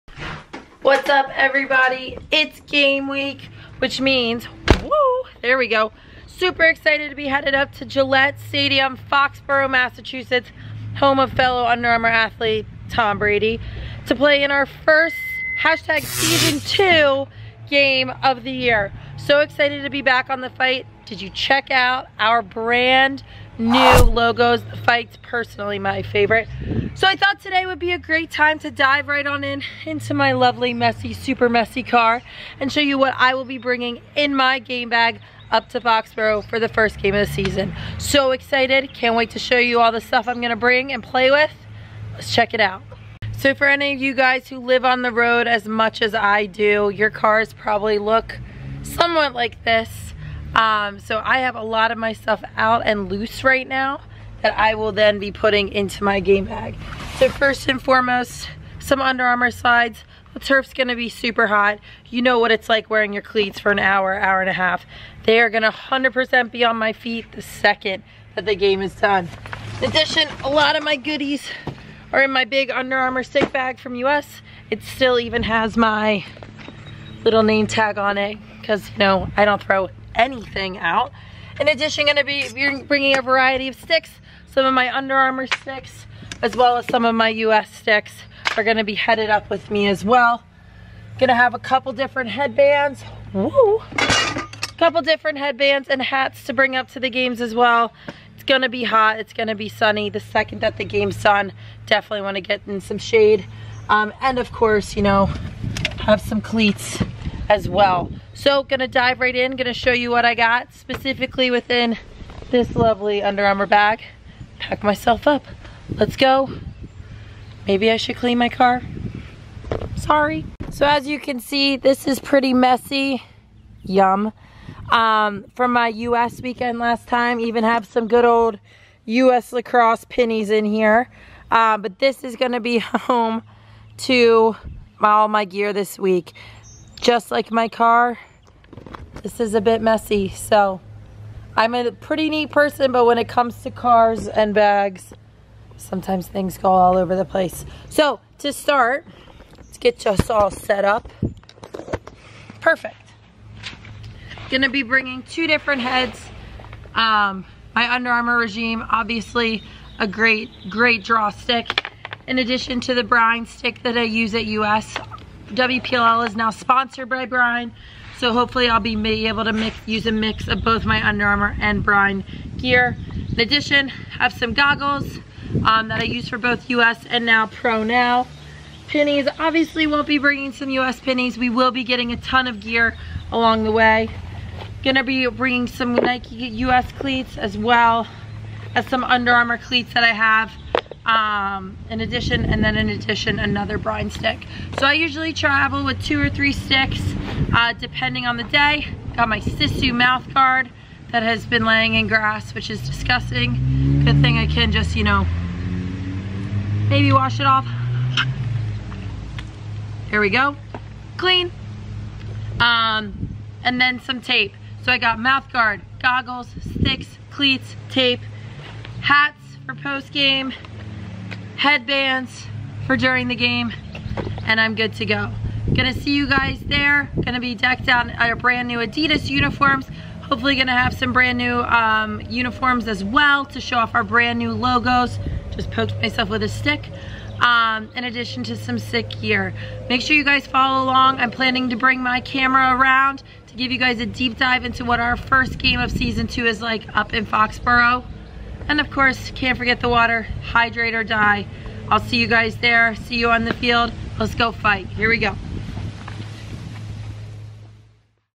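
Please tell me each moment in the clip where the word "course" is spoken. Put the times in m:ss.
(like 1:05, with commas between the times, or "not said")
1:44, 4:08.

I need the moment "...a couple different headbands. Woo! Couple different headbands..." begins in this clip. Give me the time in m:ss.
1:31.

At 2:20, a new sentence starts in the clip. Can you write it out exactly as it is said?
So I'm a pretty neat person, but when it comes to cars and bags, sometimes things go all over the place.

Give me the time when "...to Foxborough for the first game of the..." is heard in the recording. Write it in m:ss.
0:35.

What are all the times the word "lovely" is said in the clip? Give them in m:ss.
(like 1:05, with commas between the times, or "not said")
0:30, 1:52.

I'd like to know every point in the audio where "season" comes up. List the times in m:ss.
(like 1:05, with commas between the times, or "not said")
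0:16, 0:37, 4:05.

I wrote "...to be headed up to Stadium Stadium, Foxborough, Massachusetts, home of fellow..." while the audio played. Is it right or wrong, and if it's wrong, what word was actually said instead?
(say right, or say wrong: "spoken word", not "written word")
wrong: "Gillette", not "Stadium".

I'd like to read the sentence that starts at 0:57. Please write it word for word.
So first and foremost, some Under Armour slides.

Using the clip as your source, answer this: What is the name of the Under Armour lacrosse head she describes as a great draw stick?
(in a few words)
Regime.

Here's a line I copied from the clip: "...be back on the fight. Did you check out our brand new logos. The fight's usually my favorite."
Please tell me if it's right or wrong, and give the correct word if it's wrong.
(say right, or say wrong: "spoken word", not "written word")
wrong: "personally", not "usually".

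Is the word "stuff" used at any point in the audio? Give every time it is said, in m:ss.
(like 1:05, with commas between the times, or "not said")
0:40, 0:52.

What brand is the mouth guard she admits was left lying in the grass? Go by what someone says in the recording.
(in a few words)
Sisu.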